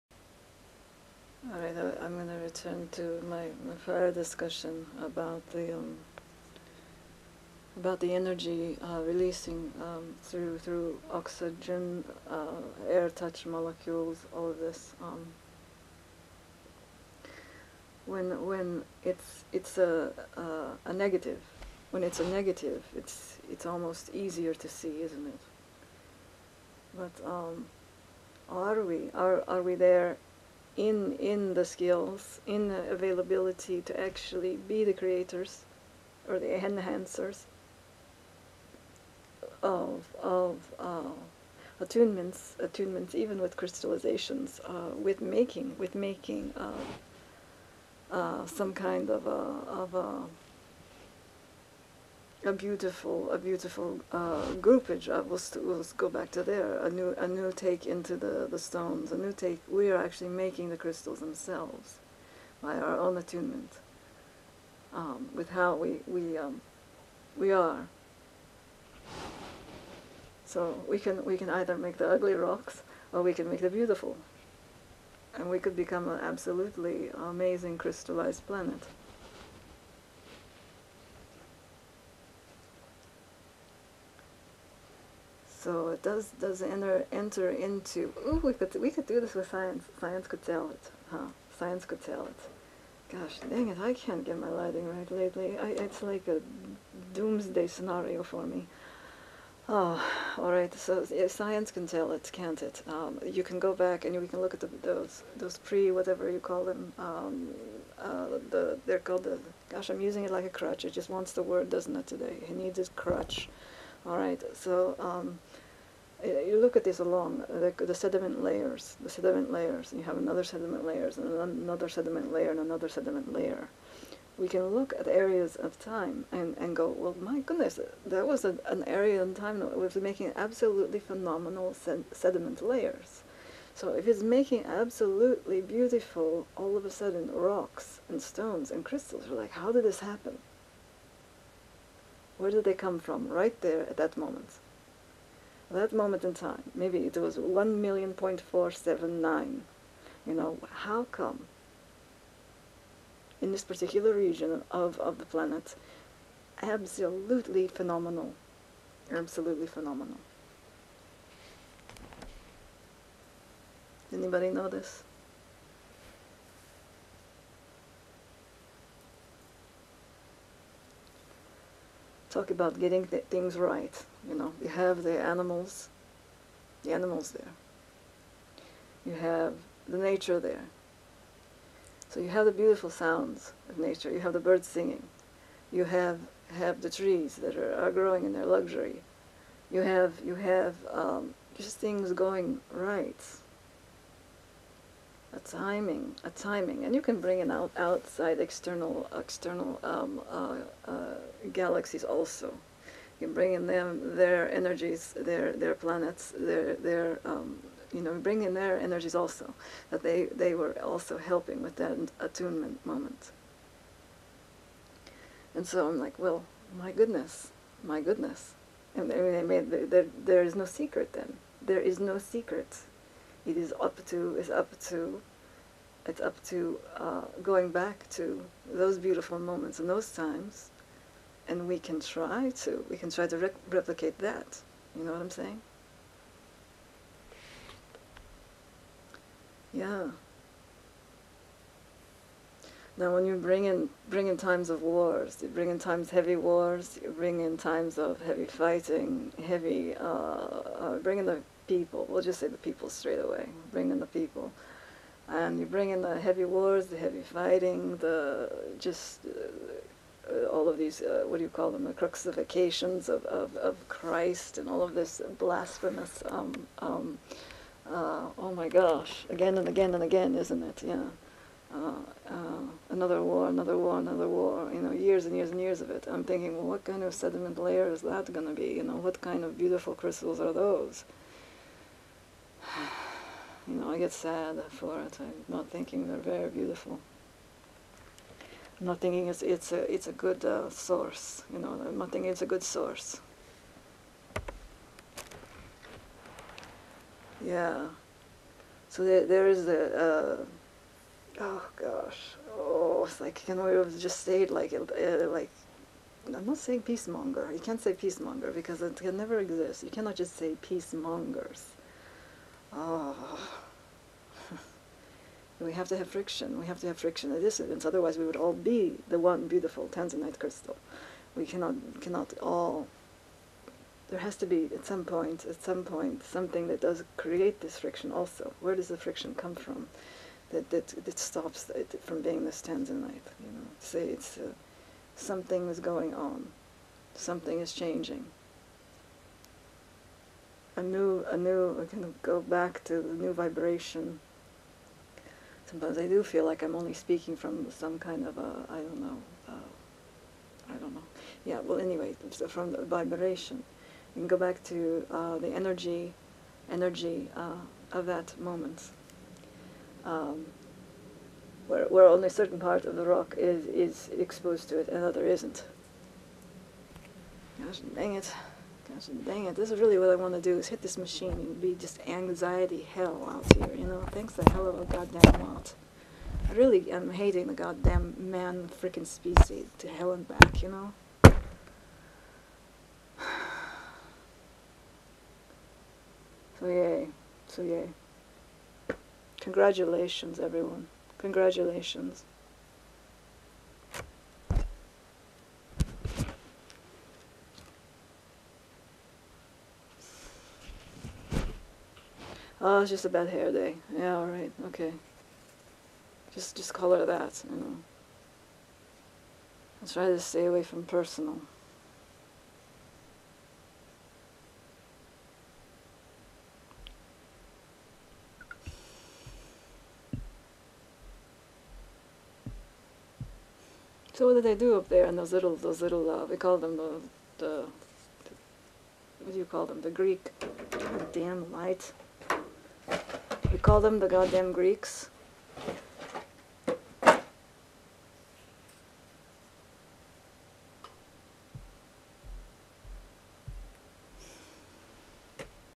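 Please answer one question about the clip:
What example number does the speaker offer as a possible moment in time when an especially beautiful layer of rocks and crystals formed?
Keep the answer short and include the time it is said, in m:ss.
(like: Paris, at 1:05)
1 million point 479, at 2:27.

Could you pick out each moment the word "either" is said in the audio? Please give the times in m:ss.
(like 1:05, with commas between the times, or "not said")
1:11.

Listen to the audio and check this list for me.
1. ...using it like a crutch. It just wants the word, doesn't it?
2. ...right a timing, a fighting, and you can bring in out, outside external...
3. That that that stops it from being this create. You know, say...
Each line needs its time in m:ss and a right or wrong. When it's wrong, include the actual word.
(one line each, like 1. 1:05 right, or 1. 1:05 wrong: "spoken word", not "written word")
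1. 1:50 right
2. 3:12 wrong: "timing", not "fighting"
3. 5:30 wrong: "tanzanite", not "create".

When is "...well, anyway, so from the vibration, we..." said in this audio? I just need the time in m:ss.
5:51.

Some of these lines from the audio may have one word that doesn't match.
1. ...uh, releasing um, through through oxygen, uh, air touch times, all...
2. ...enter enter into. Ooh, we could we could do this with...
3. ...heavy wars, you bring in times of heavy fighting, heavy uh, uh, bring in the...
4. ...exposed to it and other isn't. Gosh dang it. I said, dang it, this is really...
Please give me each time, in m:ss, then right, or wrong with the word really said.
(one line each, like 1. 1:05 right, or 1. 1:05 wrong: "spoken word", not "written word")
1. 0:08 wrong: "molecules", not "times"
2. 1:26 right
3. 4:06 right
4. 6:04 right.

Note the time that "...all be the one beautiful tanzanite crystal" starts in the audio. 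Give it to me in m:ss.
5:18.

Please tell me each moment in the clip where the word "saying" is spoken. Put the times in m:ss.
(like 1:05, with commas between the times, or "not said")
3:55, 5:06.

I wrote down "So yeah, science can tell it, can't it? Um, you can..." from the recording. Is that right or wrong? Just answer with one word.
right.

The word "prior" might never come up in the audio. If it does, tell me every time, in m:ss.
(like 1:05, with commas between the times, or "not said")
0:03.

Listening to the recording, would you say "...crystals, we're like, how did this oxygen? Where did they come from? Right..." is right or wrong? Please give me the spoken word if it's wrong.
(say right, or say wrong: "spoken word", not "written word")
wrong: "happen", not "oxygen".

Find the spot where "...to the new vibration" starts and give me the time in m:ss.
5:42.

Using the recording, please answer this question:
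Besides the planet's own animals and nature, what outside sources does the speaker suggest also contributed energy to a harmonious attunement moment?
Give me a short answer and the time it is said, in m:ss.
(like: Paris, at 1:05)
galaxies, at 3:21.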